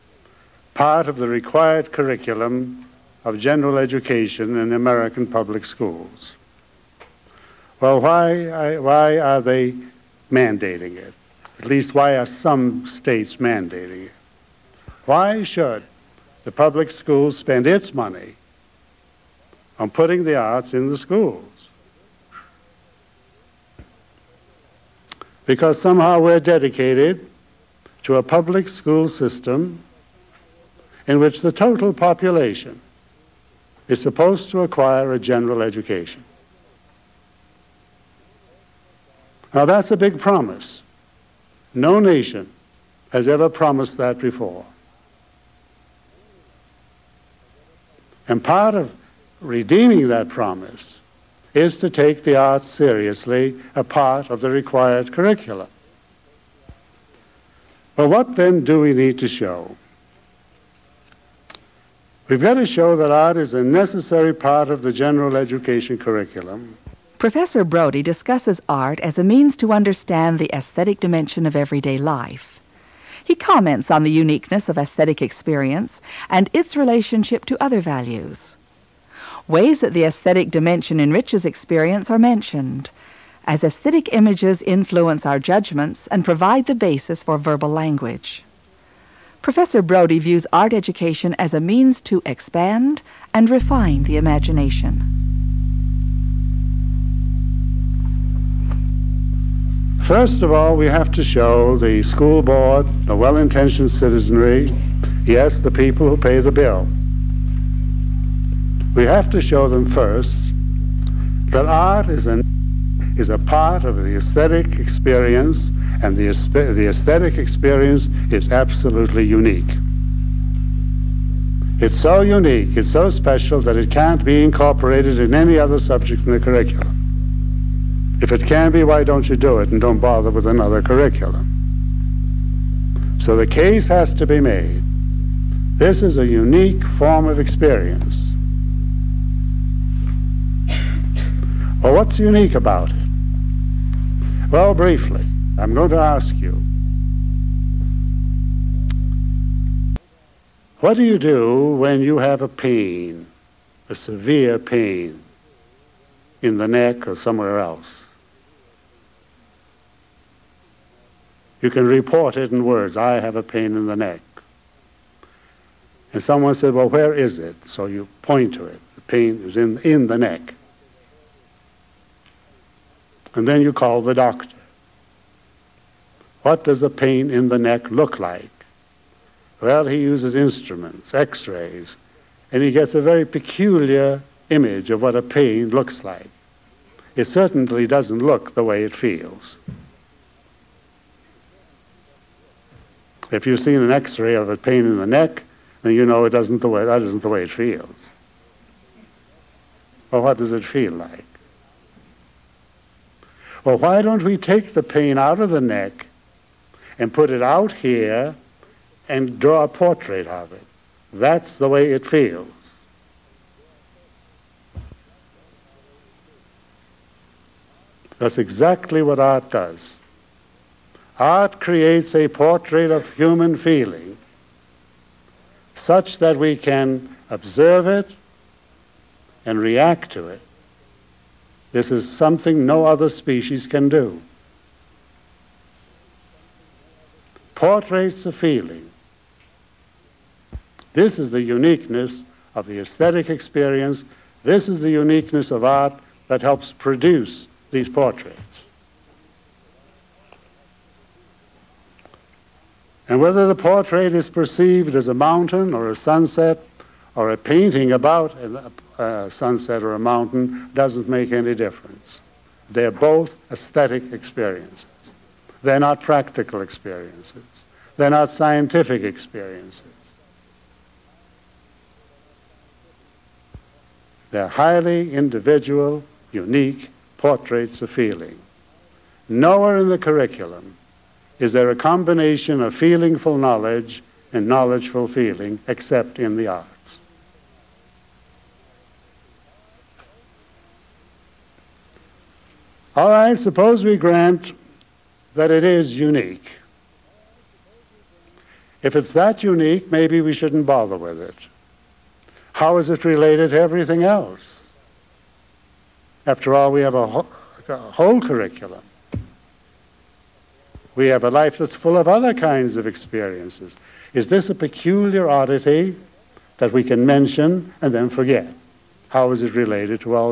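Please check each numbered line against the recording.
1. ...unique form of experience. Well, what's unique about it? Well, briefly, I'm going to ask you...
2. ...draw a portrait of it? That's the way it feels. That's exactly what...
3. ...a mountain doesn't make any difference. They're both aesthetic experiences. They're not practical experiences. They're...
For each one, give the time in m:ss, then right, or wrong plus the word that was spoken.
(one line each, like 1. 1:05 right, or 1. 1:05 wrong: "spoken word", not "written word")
1. 2:16 right
2. 3:29 right
3. 4:19 right.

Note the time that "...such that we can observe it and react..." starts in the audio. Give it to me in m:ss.
3:45.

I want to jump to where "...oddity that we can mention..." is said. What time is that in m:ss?
5:15.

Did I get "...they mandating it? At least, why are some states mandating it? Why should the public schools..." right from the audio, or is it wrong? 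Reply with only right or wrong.
right.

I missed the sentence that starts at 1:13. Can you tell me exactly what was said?
He comments on the uniqueness of aesthetic experience and its relationship to other values.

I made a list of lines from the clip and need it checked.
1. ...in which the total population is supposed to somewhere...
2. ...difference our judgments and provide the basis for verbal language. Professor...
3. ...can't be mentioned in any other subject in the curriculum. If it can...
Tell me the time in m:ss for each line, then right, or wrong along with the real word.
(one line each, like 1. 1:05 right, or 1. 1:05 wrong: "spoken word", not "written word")
1. 0:31 wrong: "acquire", not "somewhere"
2. 1:24 wrong: "influence", not "difference"
3. 2:03 wrong: "incorporated", not "mentioned".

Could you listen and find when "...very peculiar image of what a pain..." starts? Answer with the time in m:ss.
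3:02.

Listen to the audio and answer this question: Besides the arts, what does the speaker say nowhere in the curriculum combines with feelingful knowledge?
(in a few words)
knowledgeful feeling.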